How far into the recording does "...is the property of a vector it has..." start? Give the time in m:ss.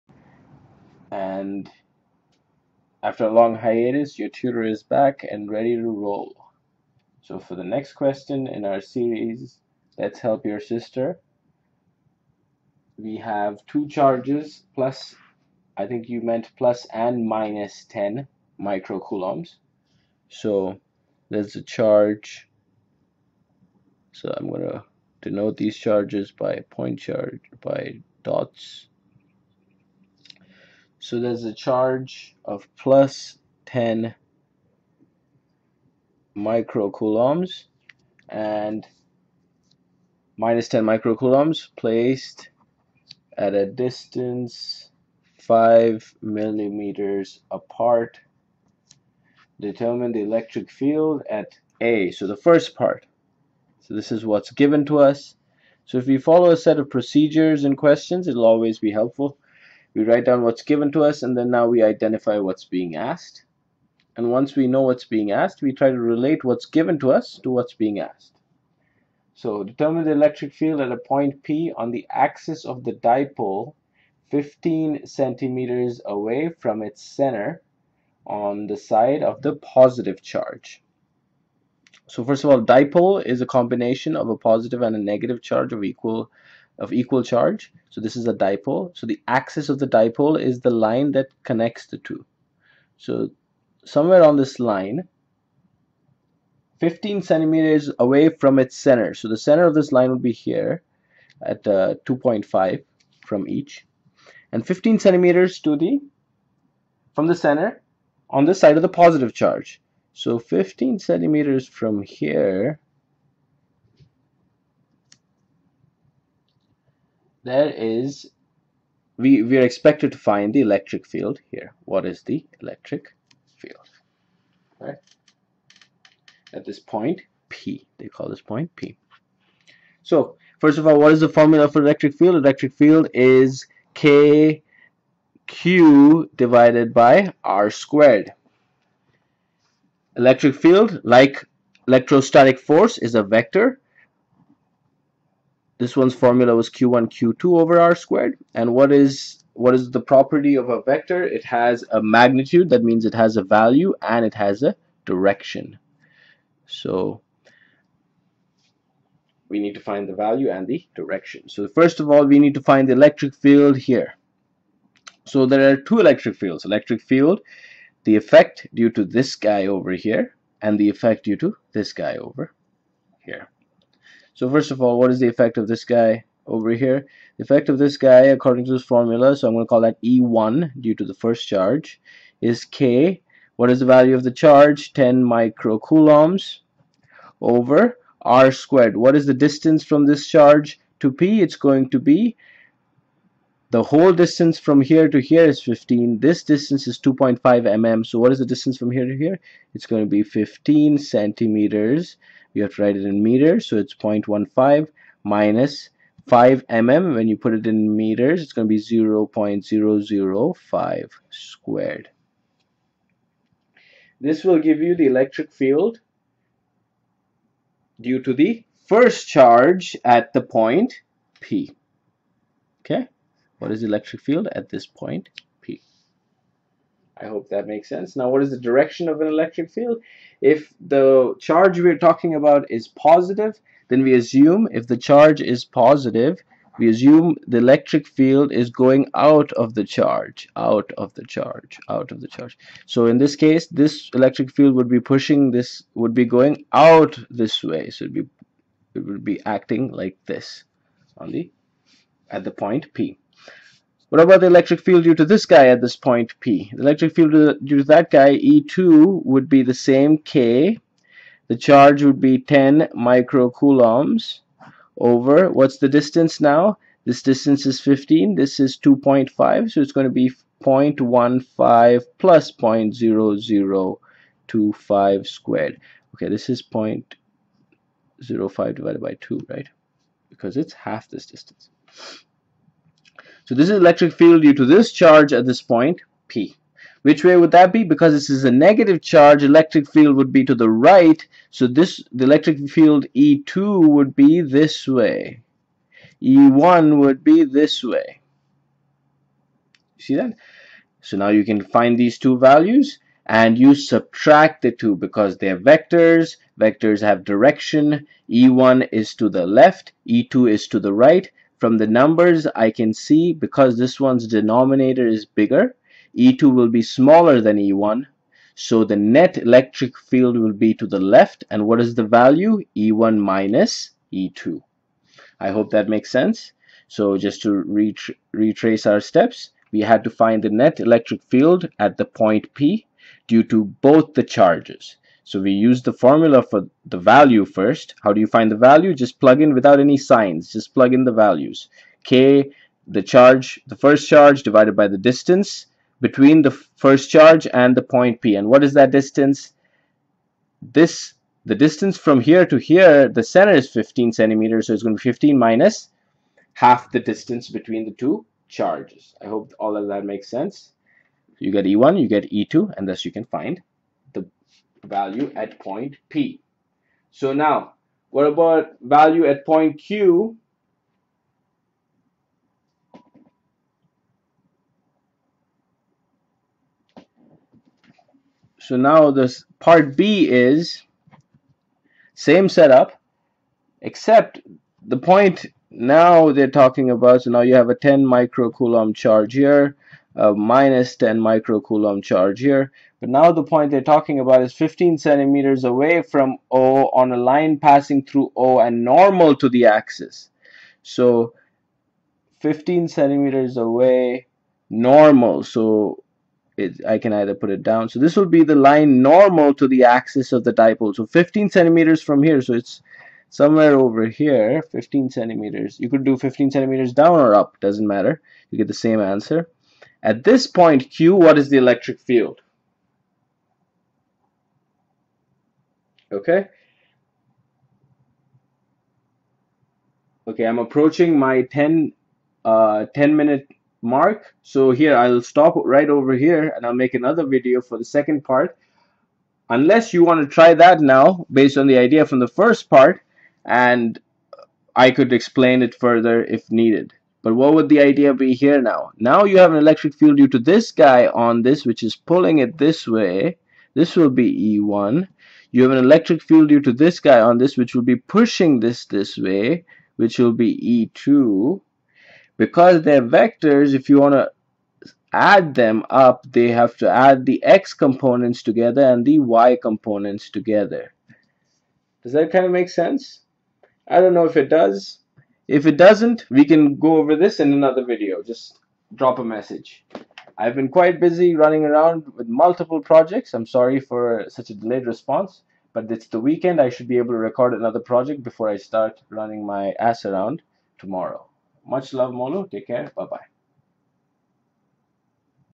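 2:29.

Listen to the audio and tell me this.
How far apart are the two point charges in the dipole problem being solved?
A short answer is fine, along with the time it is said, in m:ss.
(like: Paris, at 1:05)
5 millimeters, at 0:45.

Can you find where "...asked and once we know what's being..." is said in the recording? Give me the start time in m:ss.
1:02.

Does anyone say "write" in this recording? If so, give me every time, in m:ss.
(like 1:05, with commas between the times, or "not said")
1:00, 3:22.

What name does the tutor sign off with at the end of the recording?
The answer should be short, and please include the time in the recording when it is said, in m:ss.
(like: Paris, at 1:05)
Molo, at 8:12.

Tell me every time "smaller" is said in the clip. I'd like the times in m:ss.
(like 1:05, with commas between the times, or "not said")
5:16.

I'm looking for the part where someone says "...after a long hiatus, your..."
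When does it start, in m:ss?
0:03.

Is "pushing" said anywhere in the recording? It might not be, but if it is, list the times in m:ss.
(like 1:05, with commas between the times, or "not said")
4:05, 7:37.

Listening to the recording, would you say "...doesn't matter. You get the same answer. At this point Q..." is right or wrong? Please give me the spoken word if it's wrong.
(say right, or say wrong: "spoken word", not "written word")
right.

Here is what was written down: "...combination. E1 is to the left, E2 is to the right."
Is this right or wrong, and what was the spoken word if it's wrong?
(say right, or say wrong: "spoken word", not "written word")
wrong: "direction", not "combination".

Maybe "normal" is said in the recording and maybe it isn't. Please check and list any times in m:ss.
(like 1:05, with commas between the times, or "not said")
6:38, 6:44, 6:49.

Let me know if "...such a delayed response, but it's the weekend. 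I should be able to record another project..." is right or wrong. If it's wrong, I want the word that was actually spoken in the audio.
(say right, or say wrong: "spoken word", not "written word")
right.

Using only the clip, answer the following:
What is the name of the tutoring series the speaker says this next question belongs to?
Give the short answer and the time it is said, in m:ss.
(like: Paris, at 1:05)
Let's Help Your Sister, at 0:09.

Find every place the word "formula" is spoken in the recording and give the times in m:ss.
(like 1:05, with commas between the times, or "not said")
2:11, 2:26, 2:58, 5:35.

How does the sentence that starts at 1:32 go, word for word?
So somewhere on this line, 15 centimeters away from its center.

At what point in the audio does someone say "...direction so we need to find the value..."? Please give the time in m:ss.
2:35.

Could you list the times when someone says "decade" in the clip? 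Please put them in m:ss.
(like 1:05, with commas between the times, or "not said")
not said.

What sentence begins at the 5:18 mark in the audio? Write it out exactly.
So the net electric field will be to the left.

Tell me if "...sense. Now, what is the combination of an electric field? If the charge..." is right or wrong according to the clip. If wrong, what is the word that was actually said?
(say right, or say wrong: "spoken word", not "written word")
wrong: "direction", not "combination".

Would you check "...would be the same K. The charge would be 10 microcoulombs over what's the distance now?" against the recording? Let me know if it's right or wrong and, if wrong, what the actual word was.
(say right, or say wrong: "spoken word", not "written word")
right.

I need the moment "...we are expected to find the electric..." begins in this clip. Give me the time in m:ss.
1:59.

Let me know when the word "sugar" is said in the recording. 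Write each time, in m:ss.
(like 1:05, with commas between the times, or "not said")
not said.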